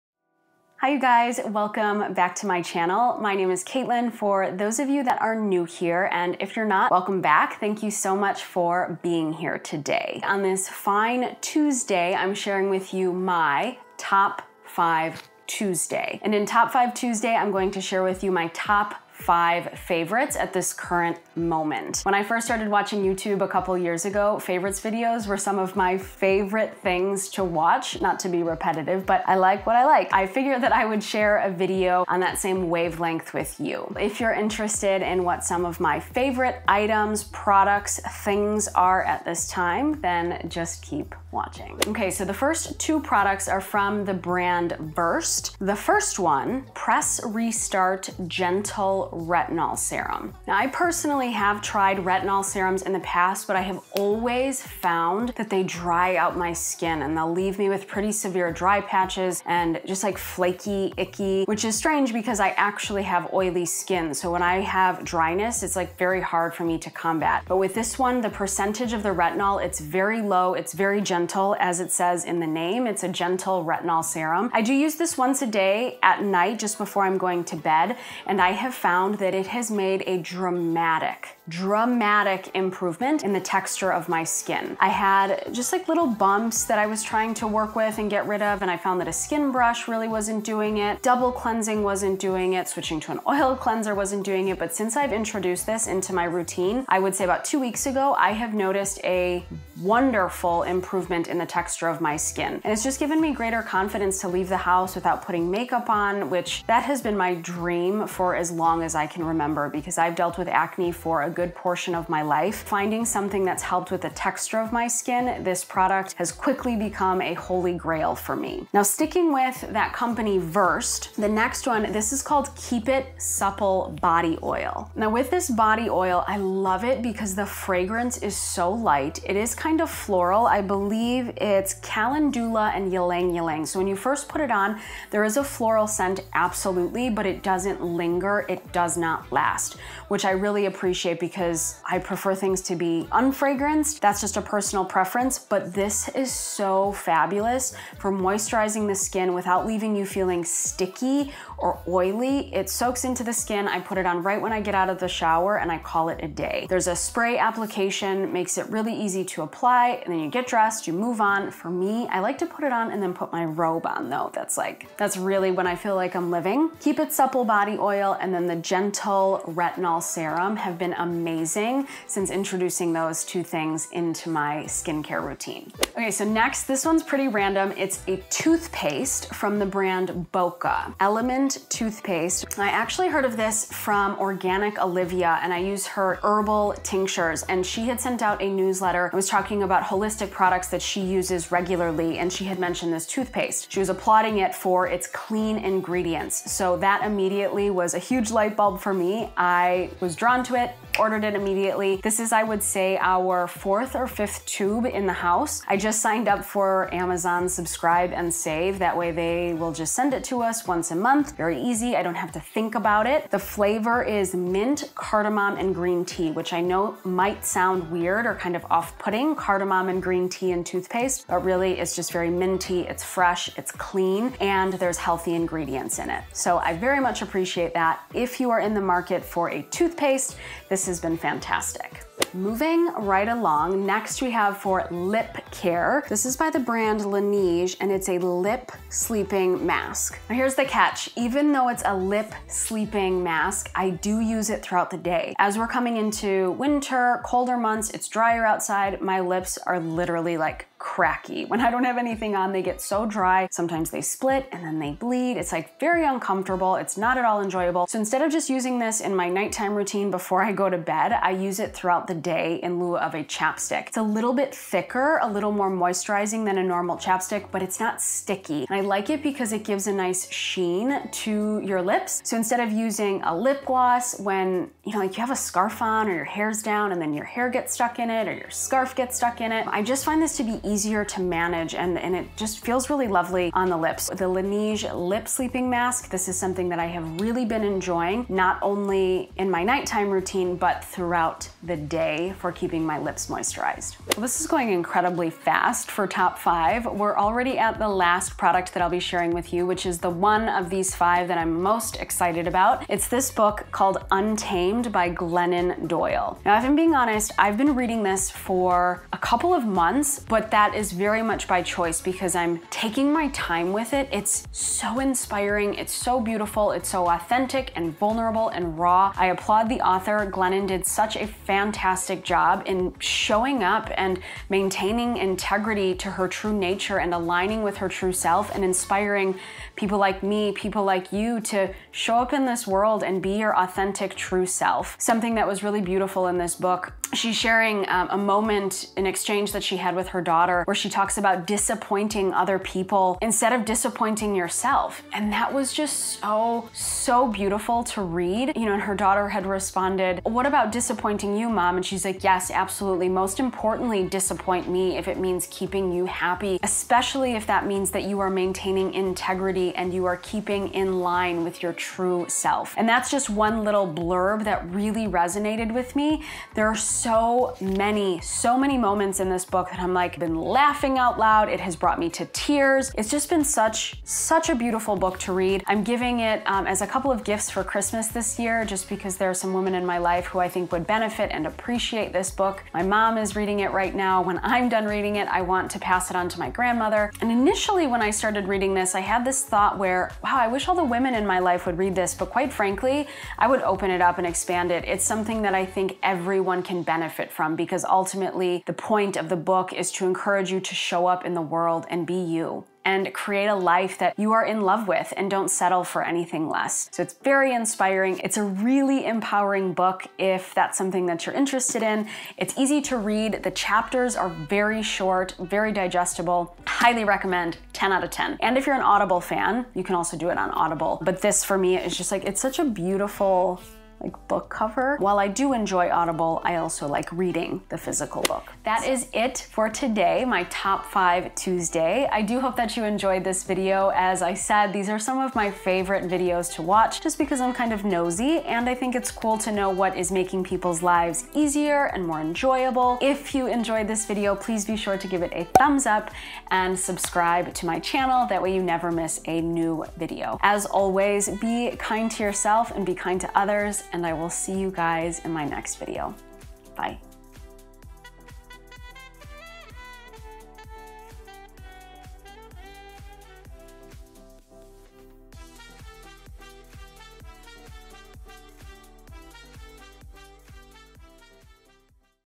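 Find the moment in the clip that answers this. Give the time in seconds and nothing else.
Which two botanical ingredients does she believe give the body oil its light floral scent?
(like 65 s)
131 s.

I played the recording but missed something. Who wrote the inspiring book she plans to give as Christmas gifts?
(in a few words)
Glennon Doyle.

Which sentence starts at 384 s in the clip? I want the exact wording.
When I'm done reading it, I want to pass it on to my grandmother.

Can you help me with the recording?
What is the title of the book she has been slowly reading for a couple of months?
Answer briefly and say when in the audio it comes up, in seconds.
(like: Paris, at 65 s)
Untamed, at 304 s.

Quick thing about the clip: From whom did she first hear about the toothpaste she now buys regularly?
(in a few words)
Organic Olivia.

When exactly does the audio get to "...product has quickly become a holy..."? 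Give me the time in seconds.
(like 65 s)
115 s.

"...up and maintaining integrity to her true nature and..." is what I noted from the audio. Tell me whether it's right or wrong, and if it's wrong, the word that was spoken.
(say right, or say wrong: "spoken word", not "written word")
right.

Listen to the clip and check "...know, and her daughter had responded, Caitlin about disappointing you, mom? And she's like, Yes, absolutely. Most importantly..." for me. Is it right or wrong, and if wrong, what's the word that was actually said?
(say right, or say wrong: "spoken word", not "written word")
wrong: "What", not "Caitlin".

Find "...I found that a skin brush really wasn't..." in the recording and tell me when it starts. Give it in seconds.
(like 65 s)
88 s.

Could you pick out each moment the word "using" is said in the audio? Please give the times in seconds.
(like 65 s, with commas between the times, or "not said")
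258 s, 272 s.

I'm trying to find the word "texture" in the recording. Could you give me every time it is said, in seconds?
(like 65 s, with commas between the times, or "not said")
83 s, 101 s, 114 s.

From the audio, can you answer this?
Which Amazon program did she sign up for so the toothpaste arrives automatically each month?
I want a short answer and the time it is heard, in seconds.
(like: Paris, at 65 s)
Subscribe and Save, at 207 s.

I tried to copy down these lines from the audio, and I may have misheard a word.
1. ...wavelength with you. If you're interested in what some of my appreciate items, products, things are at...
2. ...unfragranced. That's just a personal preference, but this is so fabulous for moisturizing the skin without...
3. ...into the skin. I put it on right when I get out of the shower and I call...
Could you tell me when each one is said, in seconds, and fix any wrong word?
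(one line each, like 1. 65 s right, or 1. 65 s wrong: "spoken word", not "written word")
1. 32 s wrong: "favorite", not "appreciate"
2. 143 s right
3. 153 s right.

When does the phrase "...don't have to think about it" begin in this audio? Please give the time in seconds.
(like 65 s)
212 s.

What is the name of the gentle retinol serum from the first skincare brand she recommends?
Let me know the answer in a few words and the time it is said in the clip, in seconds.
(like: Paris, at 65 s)
Press Restart, at 46 s.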